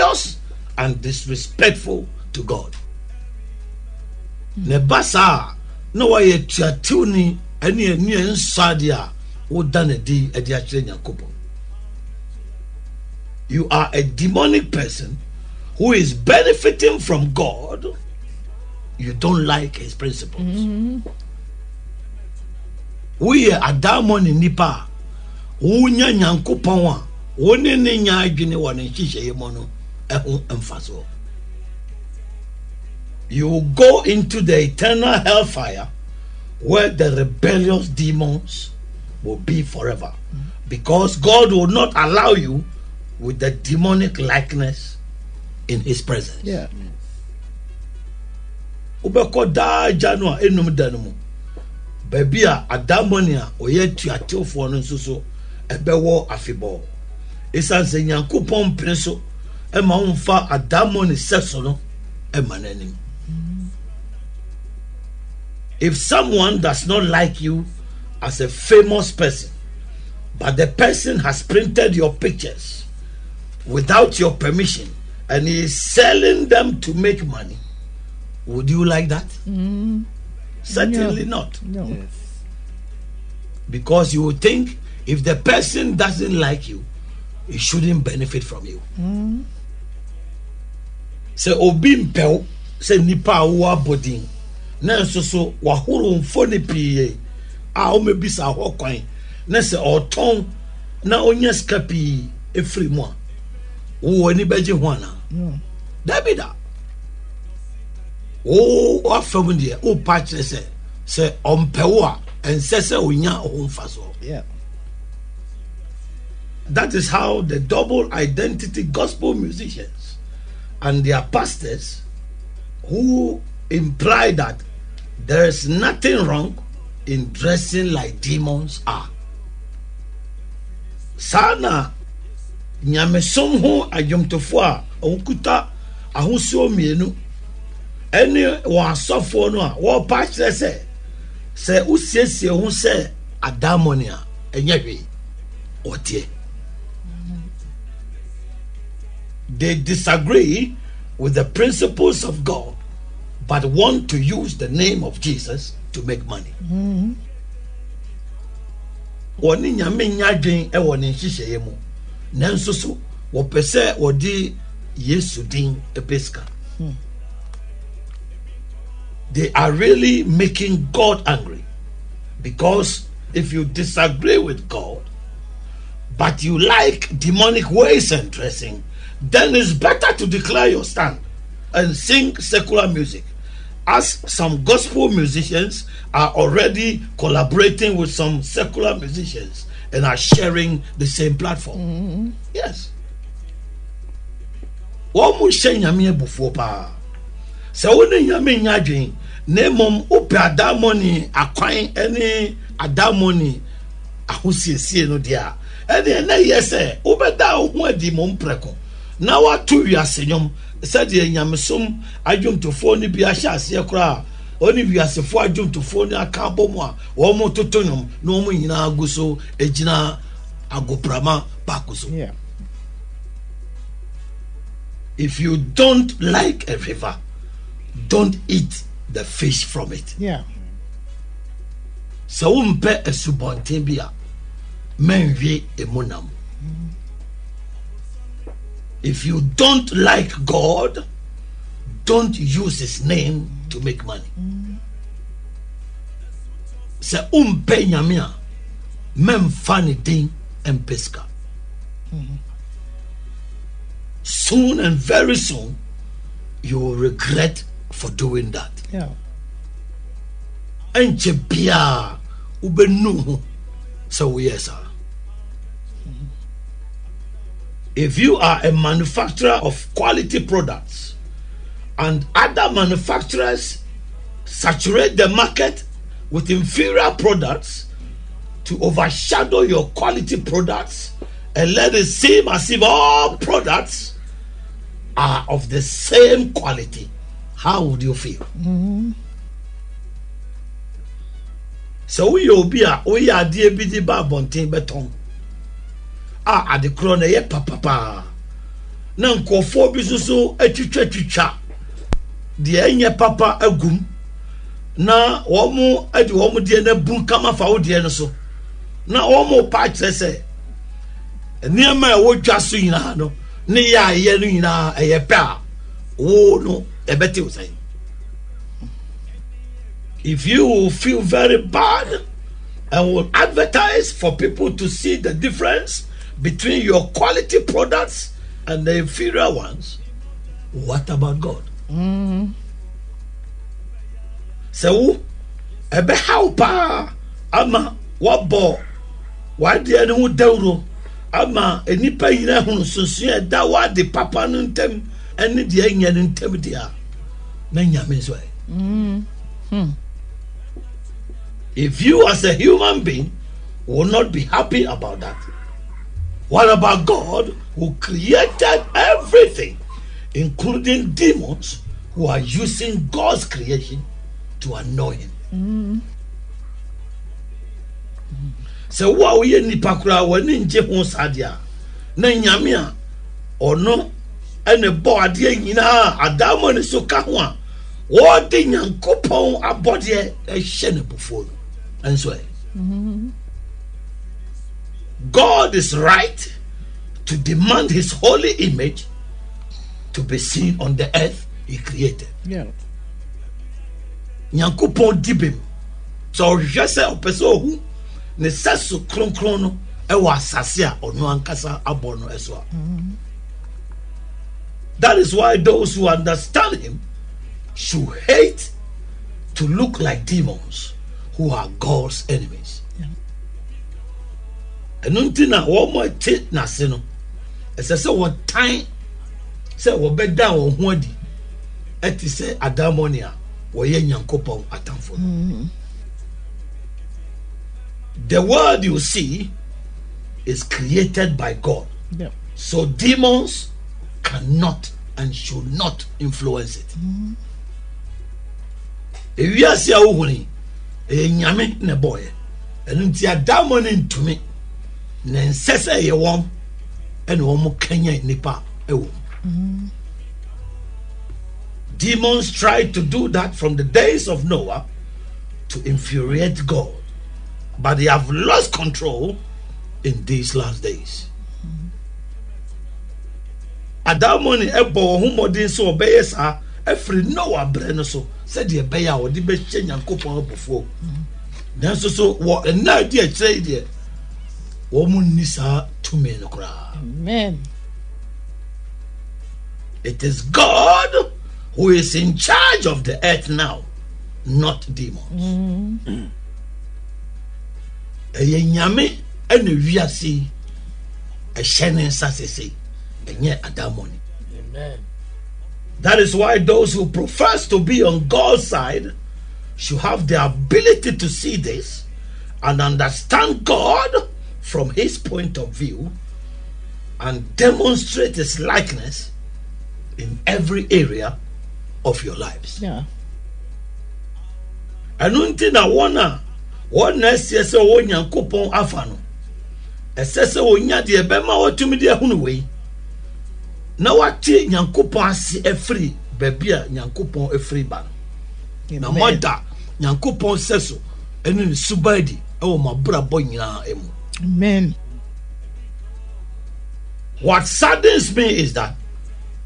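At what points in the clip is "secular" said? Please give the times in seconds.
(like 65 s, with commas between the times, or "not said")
182 s, 188 s.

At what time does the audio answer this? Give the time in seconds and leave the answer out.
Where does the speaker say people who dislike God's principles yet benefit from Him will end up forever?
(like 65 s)
34 s.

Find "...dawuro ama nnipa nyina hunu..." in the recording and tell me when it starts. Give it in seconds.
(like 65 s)
340 s.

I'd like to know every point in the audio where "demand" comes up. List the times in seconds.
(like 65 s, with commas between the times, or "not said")
387 s.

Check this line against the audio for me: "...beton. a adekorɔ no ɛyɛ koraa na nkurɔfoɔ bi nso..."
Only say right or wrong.
wrong.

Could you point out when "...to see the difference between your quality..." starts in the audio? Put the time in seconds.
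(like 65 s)
324 s.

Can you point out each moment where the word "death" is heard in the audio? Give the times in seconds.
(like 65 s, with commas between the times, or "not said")
not said.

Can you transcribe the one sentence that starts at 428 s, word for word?
the world you see is created by god yeah.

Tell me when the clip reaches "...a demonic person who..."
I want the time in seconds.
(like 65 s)
13 s.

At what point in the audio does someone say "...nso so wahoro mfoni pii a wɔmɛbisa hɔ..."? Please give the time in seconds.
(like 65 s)
95 s.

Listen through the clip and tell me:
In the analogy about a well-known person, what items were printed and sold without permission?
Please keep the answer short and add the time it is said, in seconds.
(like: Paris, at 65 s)
pictures, at 72 s.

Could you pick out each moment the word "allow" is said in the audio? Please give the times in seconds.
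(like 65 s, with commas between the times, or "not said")
41 s.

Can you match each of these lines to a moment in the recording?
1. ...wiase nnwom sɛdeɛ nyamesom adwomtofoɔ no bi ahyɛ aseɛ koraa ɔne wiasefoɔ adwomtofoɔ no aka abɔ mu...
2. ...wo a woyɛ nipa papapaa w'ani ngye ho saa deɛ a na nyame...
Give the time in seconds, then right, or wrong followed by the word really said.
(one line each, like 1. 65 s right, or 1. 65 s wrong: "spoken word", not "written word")
1. 209 s right
2. 369 s wrong: "koraa", not "papapaa".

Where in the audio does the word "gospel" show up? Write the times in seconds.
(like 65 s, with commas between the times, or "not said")
118 s, 184 s.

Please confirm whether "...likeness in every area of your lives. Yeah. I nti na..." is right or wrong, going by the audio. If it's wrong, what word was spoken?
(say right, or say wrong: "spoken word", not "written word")
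right.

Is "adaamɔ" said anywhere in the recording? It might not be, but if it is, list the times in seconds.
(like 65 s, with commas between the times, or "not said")
23 s.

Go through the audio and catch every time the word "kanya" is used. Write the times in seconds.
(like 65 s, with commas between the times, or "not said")
447 s.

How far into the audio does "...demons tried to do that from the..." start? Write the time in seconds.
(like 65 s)
451 s.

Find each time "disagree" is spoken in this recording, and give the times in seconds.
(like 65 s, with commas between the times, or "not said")
149 s, 173 s.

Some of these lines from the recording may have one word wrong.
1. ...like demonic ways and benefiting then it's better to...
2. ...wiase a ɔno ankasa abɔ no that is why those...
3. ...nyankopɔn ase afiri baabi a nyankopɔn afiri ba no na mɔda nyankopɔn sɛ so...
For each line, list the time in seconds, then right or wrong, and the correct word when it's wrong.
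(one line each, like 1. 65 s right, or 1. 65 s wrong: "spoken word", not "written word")
1. 176 s wrong: "dressing", not "benefiting"
2. 400 s wrong: "asase", not "wiase"
3. 524 s right.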